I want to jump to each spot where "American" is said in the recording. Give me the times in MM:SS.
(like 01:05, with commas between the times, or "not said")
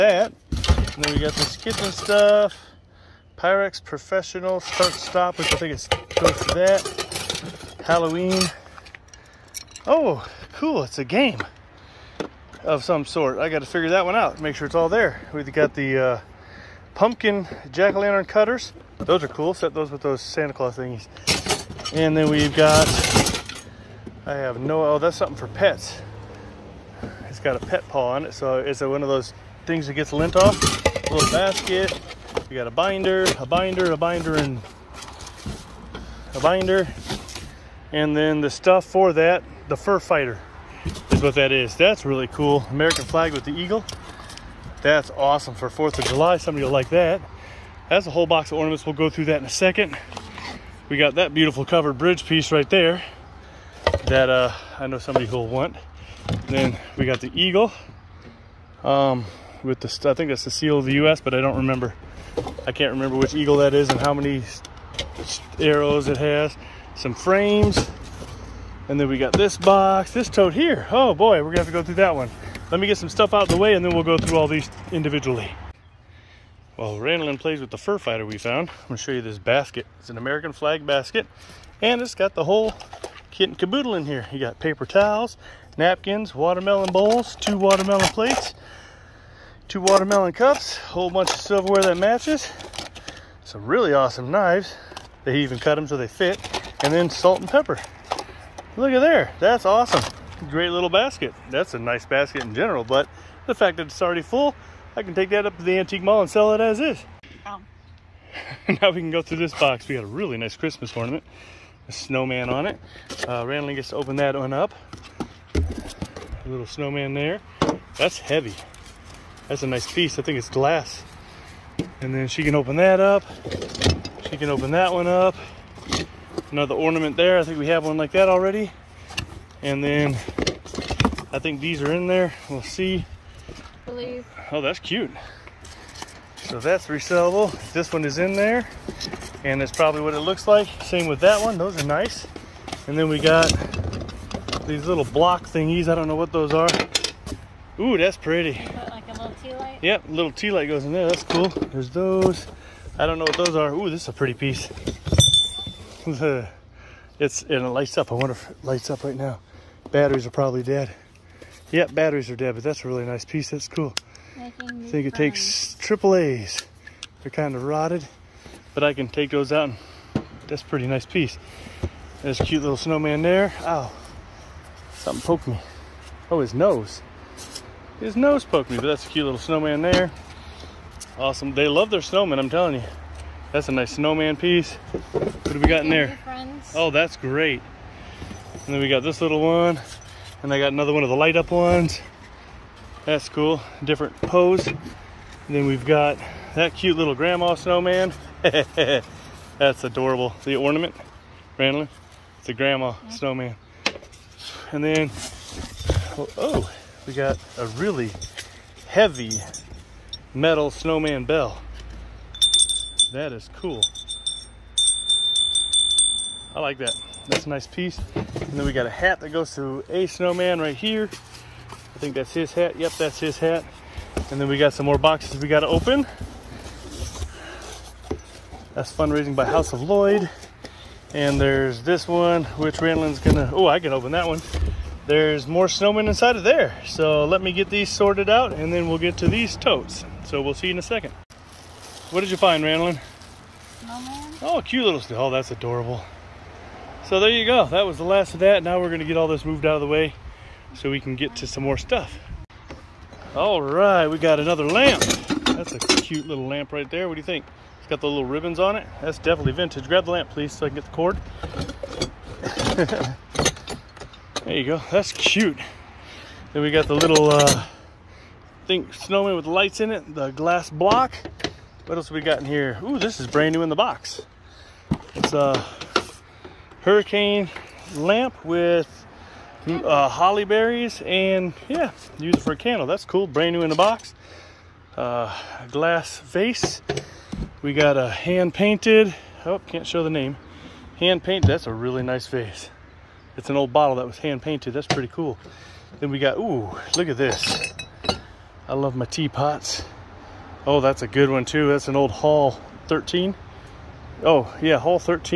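00:42, 01:20.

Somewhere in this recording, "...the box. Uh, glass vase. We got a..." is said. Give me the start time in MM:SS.
04:43.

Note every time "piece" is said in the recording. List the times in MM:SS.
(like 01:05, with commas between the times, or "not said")
00:52, 01:59, 02:34, 02:43, 02:51, 03:04, 03:37.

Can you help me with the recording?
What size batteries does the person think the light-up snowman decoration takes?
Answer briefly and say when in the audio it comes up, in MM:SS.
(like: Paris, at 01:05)
Triple A, at 02:45.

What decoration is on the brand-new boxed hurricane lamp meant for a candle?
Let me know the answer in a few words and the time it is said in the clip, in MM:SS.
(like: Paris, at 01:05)
Holly berries, at 04:40.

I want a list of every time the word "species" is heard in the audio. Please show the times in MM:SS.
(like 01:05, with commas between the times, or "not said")
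not said.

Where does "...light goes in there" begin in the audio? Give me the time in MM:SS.
02:30.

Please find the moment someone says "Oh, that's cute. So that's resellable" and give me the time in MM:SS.
02:14.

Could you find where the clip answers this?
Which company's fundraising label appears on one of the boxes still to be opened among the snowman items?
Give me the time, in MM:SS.
03:49.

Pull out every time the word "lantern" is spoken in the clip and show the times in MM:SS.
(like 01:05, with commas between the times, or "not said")
00:17.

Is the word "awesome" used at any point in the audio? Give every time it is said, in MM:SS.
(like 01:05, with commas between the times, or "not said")
00:45, 01:33, 01:39, 03:01.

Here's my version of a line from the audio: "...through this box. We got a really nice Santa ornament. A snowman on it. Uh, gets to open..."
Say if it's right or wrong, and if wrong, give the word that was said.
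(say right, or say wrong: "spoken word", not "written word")
wrong: "Christmas", not "Santa".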